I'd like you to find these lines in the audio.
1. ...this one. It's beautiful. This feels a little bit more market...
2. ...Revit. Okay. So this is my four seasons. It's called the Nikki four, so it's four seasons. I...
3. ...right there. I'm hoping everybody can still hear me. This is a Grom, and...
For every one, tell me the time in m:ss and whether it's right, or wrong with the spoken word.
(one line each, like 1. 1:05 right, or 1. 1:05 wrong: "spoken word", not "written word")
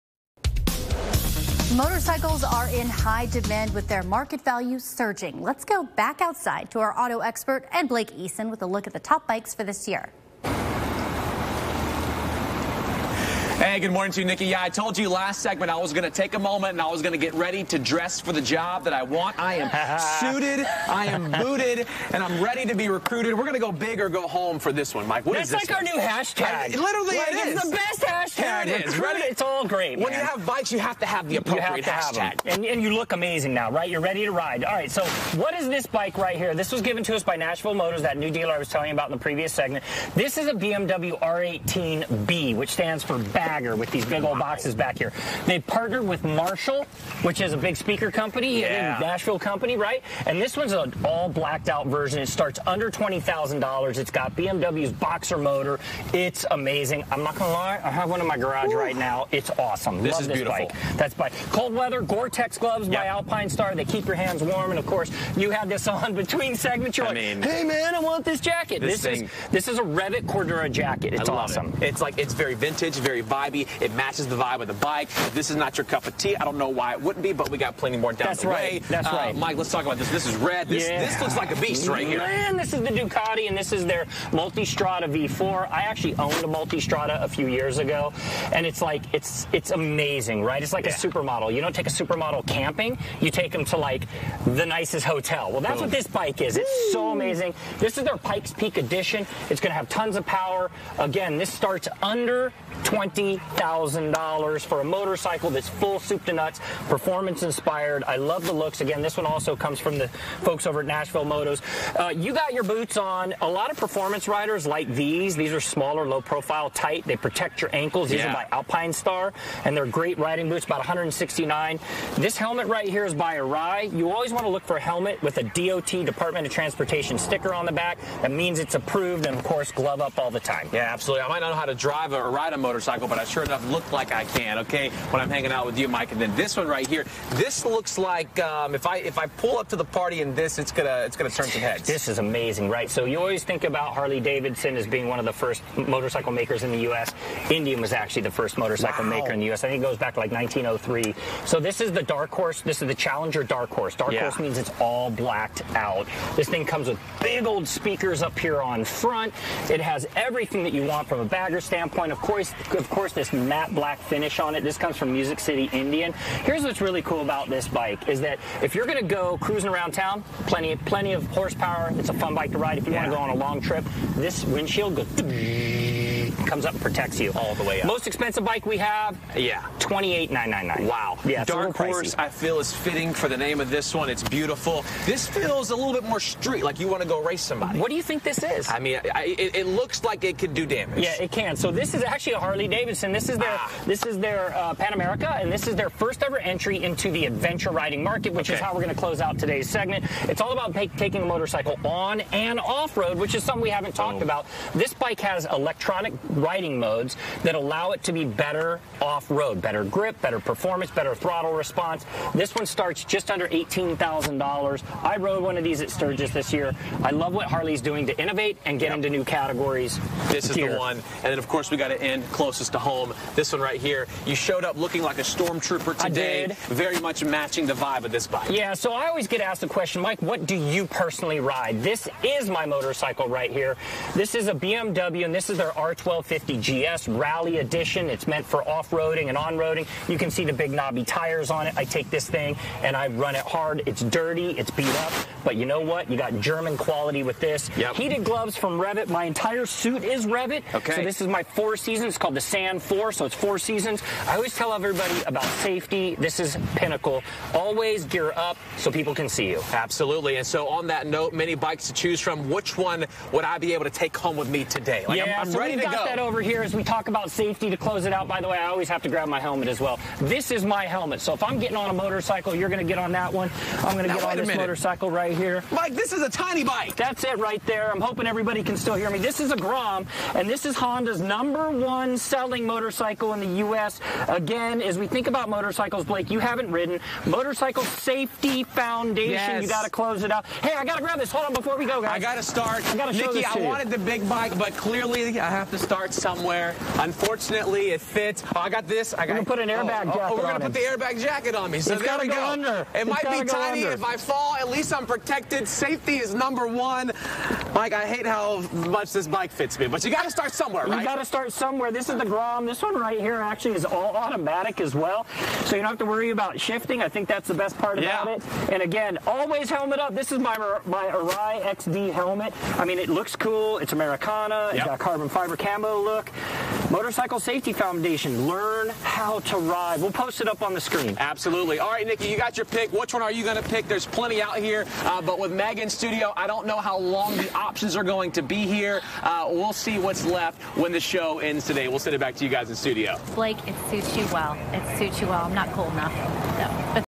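1. 3:03 wrong: "street", not "market"
2. 4:10 wrong: "Sand", not "Nikki"
3. 4:37 right.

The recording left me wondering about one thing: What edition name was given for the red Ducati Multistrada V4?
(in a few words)
Pikes Peak Edition.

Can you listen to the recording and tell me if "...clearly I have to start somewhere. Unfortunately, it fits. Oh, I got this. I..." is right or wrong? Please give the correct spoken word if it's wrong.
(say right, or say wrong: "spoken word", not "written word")
right.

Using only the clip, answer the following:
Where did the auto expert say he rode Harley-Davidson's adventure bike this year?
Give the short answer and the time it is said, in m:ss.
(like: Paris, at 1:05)
Sturgis, at 3:35.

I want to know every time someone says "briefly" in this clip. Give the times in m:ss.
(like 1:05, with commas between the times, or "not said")
not said.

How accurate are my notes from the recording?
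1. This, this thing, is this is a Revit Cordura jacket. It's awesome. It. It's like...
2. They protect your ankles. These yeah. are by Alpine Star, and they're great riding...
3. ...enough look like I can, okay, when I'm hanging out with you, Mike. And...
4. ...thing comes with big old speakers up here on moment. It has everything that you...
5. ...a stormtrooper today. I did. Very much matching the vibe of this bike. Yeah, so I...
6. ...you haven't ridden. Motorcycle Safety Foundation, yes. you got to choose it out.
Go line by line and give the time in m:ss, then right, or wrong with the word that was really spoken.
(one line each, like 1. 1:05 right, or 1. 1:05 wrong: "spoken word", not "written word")
1. 1:08 right
2. 1:57 right
3. 2:13 right
4. 2:36 wrong: "front", not "moment"
5. 3:45 right
6. 4:46 wrong: "close", not "choose".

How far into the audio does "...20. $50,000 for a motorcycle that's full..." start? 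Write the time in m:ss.
1:42.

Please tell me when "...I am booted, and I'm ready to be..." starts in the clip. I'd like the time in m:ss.
0:20.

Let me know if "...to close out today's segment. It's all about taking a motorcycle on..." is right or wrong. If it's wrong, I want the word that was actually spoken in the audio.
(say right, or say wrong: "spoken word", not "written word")
right.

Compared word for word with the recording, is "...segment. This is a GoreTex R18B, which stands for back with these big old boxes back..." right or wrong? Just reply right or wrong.
wrong.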